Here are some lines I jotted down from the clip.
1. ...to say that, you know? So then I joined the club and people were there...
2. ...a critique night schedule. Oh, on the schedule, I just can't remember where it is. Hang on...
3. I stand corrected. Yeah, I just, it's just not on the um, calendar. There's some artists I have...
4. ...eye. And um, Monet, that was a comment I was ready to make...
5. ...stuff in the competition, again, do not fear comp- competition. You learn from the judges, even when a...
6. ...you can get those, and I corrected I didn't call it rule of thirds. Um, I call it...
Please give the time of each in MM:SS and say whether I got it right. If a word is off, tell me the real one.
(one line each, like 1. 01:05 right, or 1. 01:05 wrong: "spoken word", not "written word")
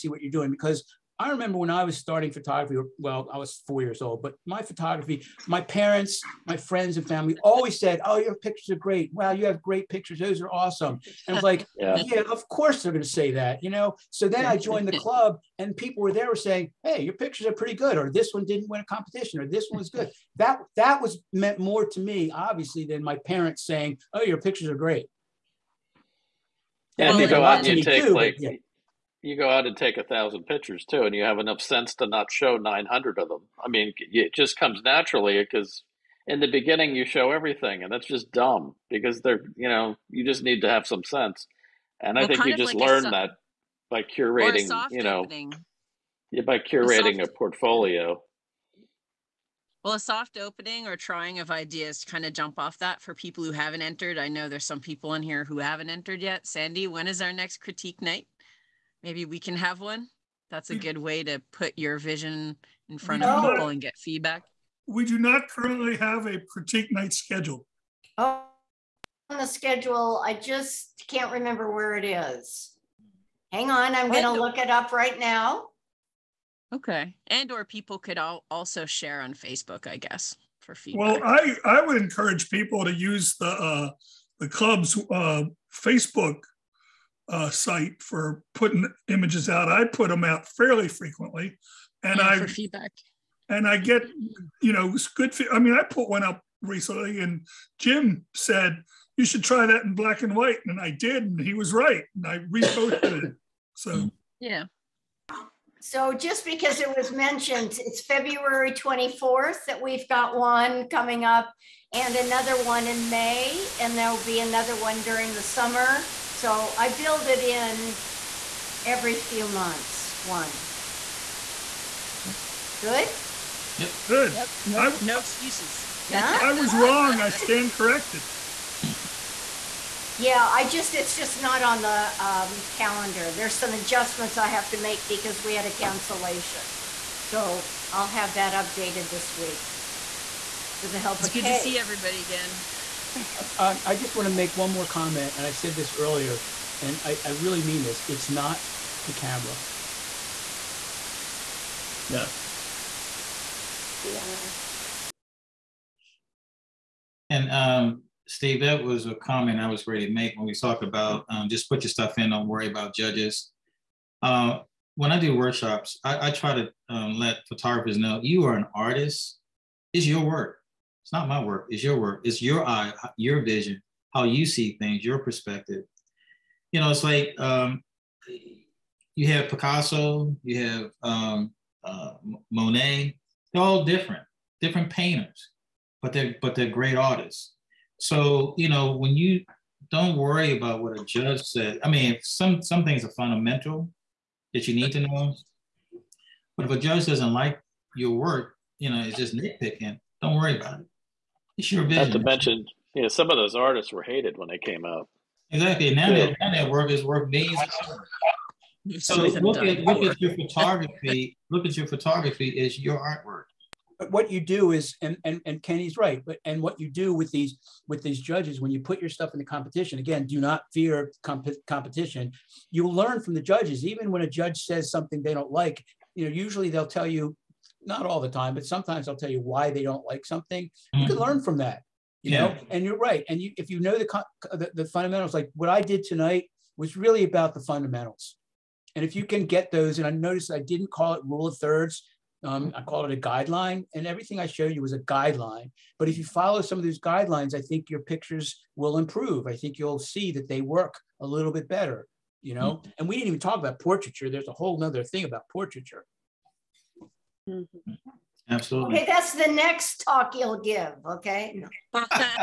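1. 00:13 right
2. 01:06 right
3. 02:07 wrong: "adjustments", not "artists"
4. 02:34 wrong: "Steve", not "Monet"
5. 03:39 right
6. 03:59 wrong: "noticed", not "corrected".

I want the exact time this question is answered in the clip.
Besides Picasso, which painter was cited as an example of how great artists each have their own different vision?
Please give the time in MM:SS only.
03:02.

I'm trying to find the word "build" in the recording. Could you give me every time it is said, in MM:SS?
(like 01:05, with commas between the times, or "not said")
01:56.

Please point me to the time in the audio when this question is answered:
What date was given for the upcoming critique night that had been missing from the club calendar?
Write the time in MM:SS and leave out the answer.
01:48.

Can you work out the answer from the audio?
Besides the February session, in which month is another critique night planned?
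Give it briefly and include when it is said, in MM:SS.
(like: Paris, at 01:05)
May, at 01:53.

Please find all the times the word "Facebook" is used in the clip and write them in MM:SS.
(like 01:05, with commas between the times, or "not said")
01:19, 01:25.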